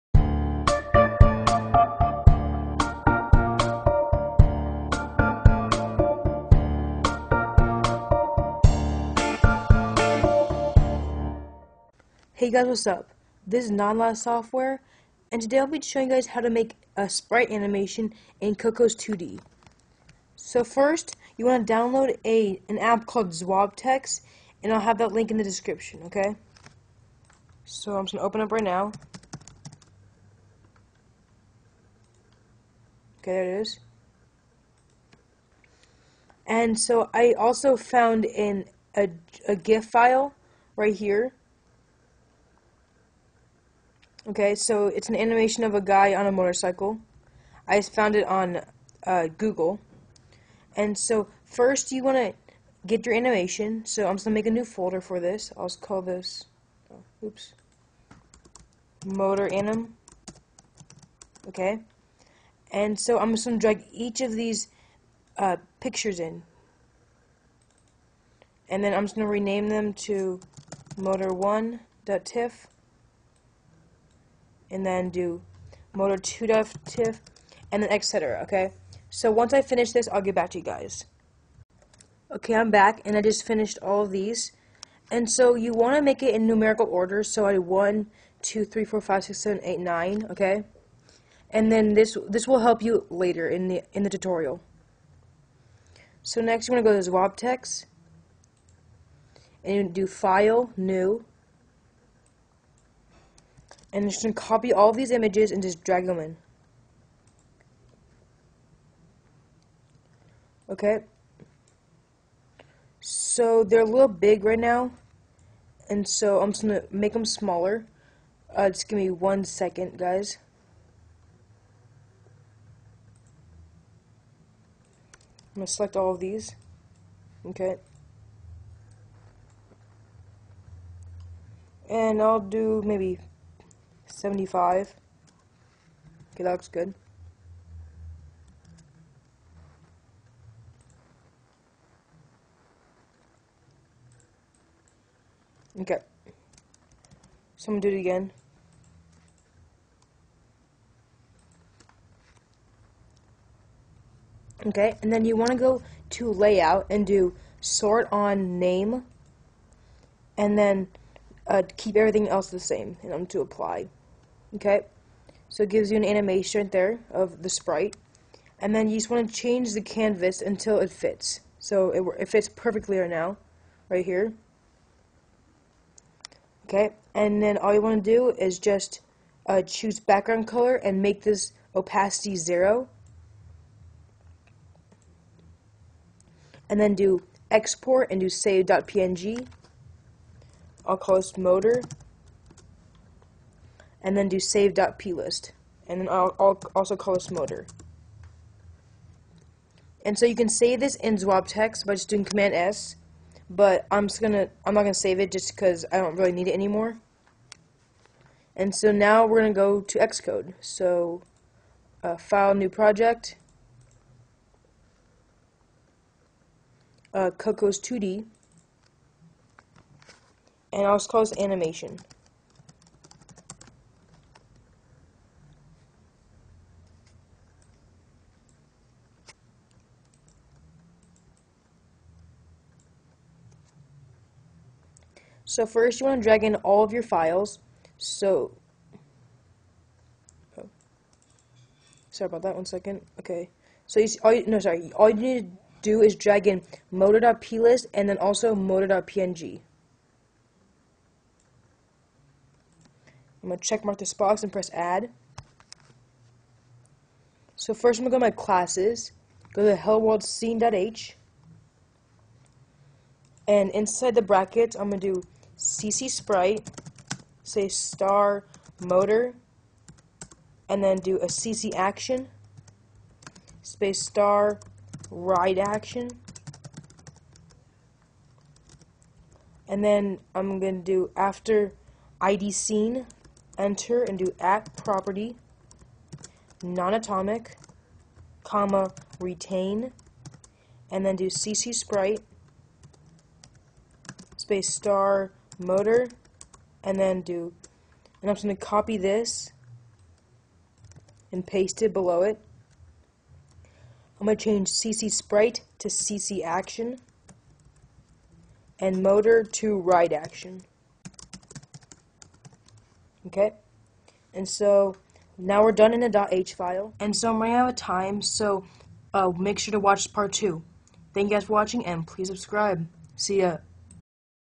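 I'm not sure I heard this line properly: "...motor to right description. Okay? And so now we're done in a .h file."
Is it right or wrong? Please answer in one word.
wrong.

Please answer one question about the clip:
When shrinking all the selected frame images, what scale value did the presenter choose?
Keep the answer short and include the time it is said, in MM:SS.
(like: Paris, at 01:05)
75, at 02:14.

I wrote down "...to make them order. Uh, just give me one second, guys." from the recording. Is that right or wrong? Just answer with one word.
wrong.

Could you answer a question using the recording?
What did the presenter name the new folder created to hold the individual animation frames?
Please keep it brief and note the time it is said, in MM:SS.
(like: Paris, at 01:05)
motor anim, at 00:59.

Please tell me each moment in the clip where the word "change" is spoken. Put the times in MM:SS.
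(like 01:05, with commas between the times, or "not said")
02:49, 05:04.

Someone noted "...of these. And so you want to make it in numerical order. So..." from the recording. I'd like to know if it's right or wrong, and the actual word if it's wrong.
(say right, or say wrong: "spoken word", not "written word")
right.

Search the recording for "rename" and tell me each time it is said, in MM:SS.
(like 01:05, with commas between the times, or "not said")
01:09.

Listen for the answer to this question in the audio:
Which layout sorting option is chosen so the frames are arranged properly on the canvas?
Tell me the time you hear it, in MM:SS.
02:37.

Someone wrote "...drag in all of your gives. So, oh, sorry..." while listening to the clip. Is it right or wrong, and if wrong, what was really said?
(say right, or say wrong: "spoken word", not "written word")
wrong: "files", not "gives".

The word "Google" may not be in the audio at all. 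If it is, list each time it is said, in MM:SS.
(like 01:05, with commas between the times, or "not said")
00:49.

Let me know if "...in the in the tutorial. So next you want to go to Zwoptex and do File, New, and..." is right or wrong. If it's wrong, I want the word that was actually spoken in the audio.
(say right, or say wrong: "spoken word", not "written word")
right.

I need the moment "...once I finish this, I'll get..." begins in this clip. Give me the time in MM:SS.
01:19.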